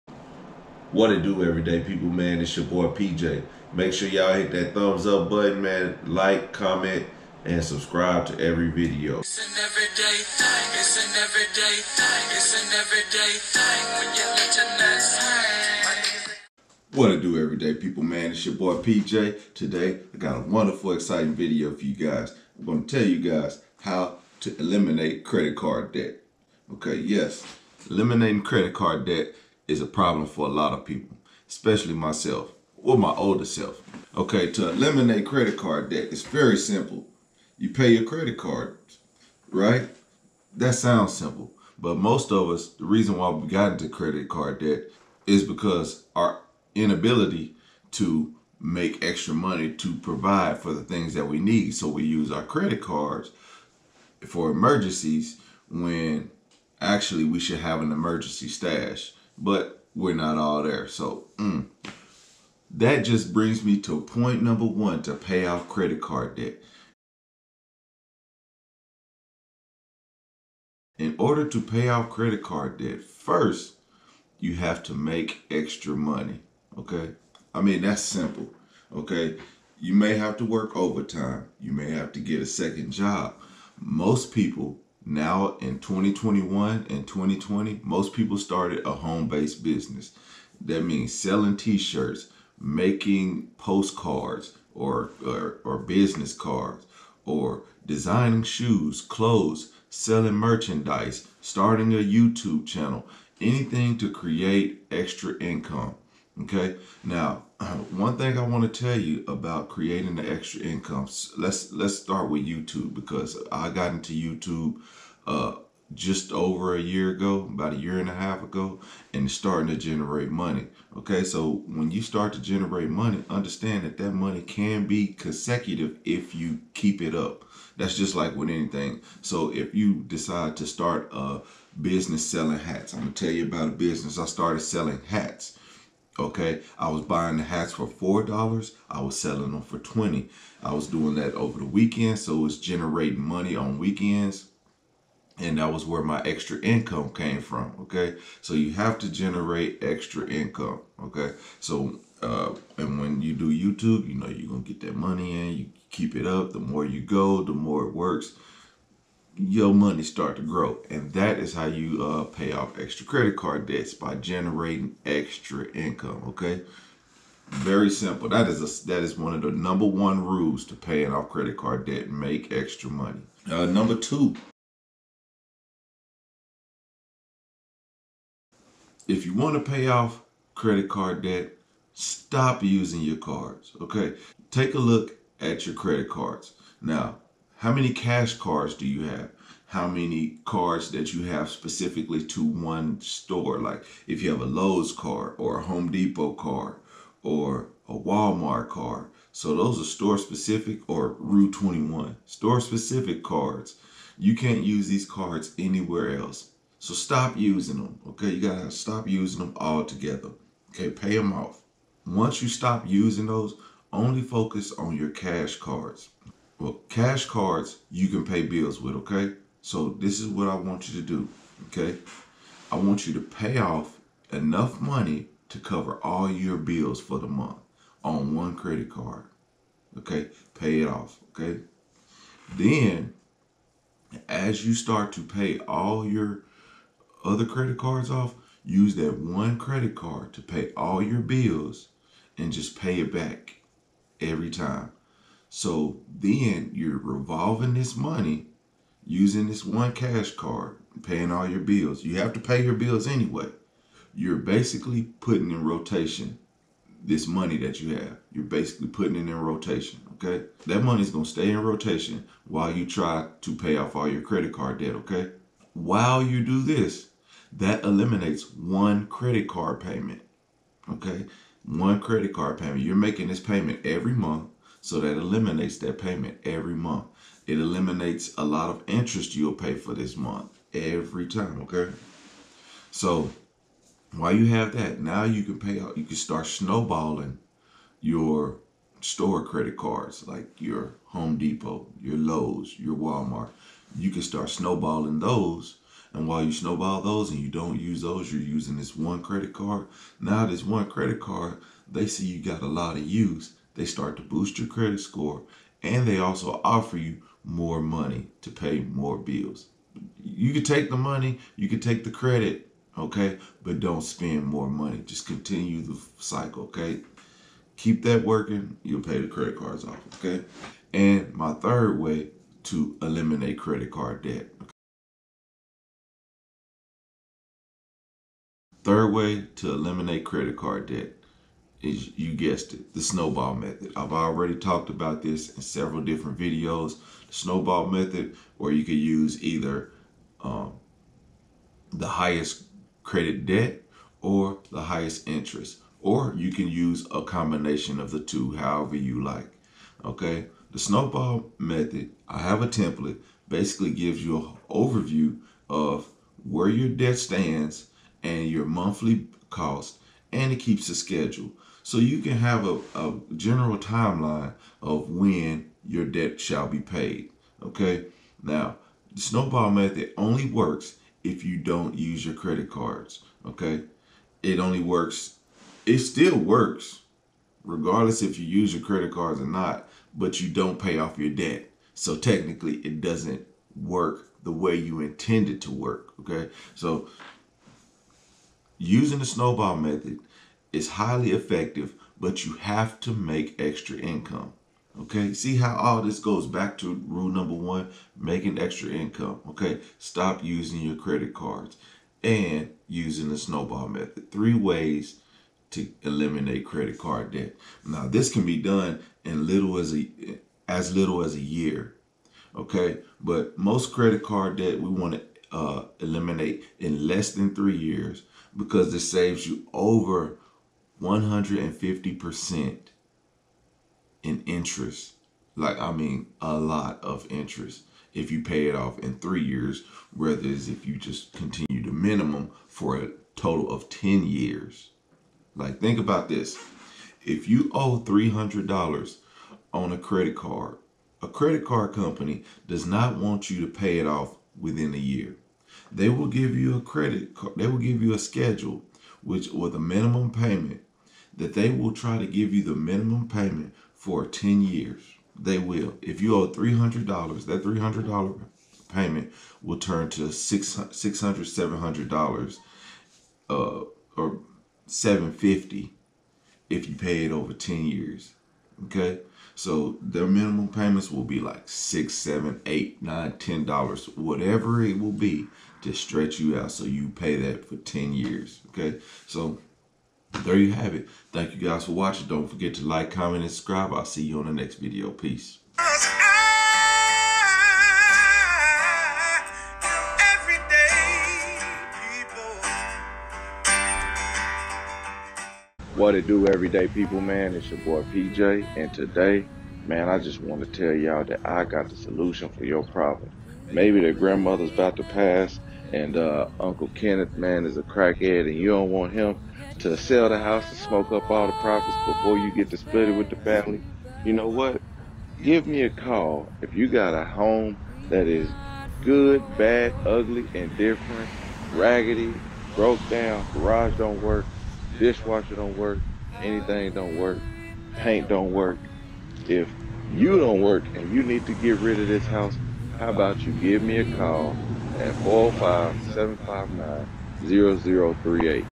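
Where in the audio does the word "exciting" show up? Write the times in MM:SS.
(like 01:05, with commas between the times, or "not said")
00:20.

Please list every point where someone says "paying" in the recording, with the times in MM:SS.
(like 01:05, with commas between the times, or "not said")
02:50, 04:11.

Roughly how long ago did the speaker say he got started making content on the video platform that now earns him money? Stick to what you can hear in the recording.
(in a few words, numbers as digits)
about a year and a half.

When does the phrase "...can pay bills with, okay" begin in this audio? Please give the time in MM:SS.
03:38.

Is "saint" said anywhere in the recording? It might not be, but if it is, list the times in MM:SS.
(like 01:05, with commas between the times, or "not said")
not said.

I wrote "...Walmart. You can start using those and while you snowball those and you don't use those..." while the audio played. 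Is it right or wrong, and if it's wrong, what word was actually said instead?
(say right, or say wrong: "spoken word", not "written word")
wrong: "snowballing", not "using".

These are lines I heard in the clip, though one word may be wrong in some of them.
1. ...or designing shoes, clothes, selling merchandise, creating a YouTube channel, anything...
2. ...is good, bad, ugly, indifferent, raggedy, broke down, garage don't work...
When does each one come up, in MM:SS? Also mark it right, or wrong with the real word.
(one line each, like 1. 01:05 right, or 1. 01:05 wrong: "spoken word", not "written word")
1. 01:37 wrong: "starting", not "creating"
2. 08:38 right.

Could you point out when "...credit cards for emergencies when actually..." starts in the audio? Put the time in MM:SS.
00:52.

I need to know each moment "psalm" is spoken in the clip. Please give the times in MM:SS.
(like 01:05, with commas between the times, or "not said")
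not said.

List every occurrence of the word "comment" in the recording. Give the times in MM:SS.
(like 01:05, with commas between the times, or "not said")
00:06, 08:03.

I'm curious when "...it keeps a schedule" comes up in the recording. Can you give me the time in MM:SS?
06:00.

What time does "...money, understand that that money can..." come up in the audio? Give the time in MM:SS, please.
02:02.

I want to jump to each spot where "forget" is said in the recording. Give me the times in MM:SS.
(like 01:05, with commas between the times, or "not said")
08:02.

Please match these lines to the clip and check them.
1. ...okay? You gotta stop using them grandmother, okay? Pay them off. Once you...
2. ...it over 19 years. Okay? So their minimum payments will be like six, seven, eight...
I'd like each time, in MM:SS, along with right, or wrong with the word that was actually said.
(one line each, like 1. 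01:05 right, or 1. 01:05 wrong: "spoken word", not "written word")
1. 03:28 wrong: "altogether", not "grandmother"
2. 07:47 wrong: "10", not "19".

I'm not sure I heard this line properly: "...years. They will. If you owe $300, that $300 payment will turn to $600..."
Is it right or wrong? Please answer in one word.
right.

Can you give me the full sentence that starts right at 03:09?
How many cards that you have specifically to one store?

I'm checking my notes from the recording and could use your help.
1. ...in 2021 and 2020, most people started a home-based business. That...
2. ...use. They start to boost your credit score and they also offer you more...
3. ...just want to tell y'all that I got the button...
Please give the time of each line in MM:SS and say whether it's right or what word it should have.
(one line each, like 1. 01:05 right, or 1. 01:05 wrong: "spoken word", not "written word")
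1. 01:25 right
2. 05:03 right
3. 08:20 wrong: "solution", not "button".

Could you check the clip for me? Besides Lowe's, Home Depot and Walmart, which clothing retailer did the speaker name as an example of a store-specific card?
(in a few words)
Rue 21.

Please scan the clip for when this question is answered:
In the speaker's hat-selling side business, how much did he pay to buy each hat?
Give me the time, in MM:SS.
02:17.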